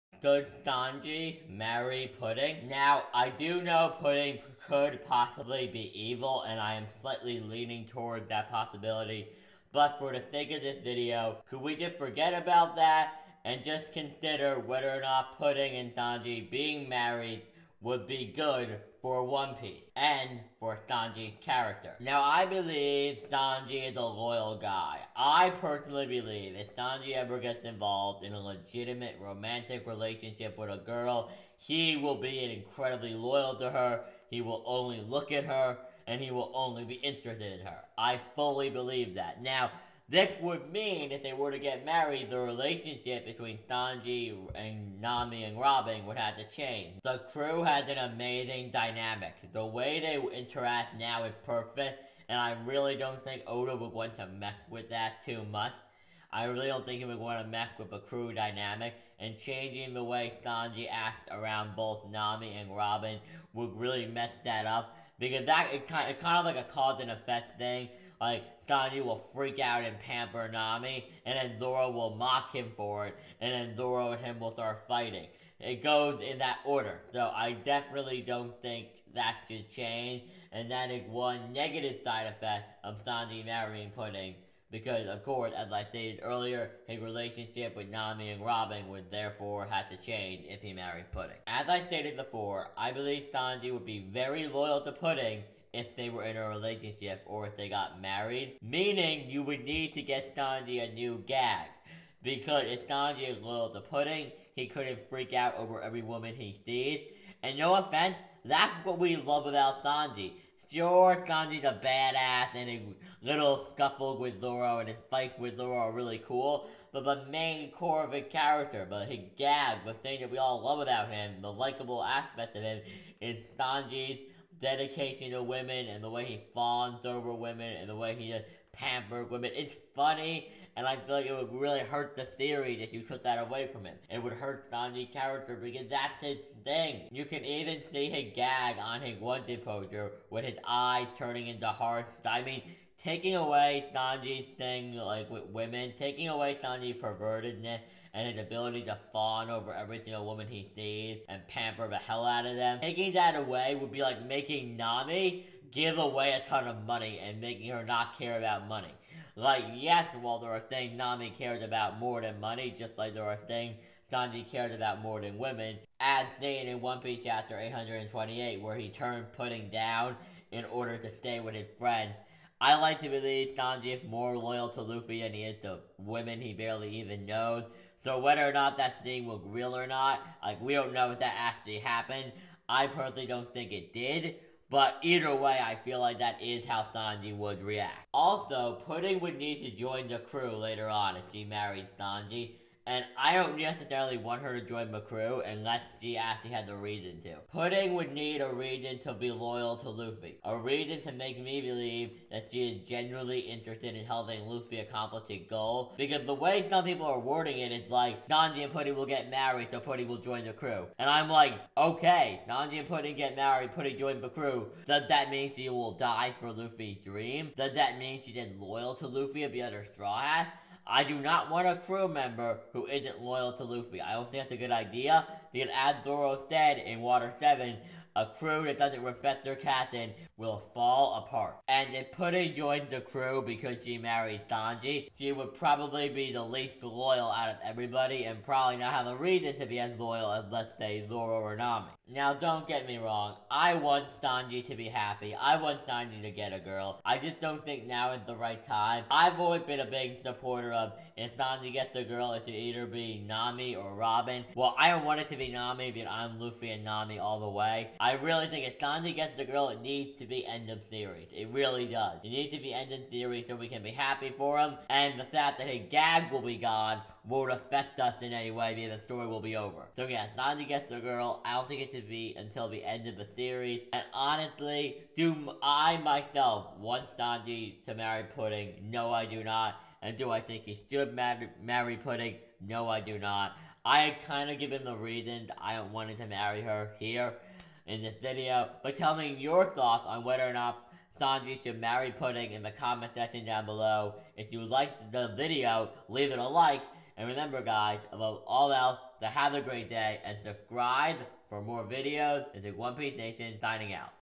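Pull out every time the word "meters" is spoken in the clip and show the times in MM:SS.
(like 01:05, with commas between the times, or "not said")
not said.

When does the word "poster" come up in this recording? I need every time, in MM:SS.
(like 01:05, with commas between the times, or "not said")
02:19.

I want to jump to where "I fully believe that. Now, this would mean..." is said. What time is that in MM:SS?
00:37.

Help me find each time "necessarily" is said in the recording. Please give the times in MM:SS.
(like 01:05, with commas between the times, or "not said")
03:13.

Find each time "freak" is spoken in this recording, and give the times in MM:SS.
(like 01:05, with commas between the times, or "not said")
01:09, 01:45.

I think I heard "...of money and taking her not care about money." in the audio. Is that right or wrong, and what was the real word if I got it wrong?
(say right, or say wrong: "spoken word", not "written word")
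wrong: "making", not "taking".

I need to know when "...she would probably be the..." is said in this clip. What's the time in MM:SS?
03:55.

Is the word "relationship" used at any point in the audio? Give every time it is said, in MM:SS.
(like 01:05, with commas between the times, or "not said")
00:29, 00:42, 01:27, 01:36.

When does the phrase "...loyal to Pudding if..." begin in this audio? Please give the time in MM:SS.
01:34.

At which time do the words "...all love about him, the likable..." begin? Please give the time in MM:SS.
02:00.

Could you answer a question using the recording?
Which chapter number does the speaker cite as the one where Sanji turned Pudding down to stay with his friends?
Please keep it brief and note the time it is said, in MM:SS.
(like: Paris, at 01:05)
828, at 02:47.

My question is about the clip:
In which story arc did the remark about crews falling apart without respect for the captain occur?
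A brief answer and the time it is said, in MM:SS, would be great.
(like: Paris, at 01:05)
Water 7, at 03:47.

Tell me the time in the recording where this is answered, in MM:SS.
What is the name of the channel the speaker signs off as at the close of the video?
05:02.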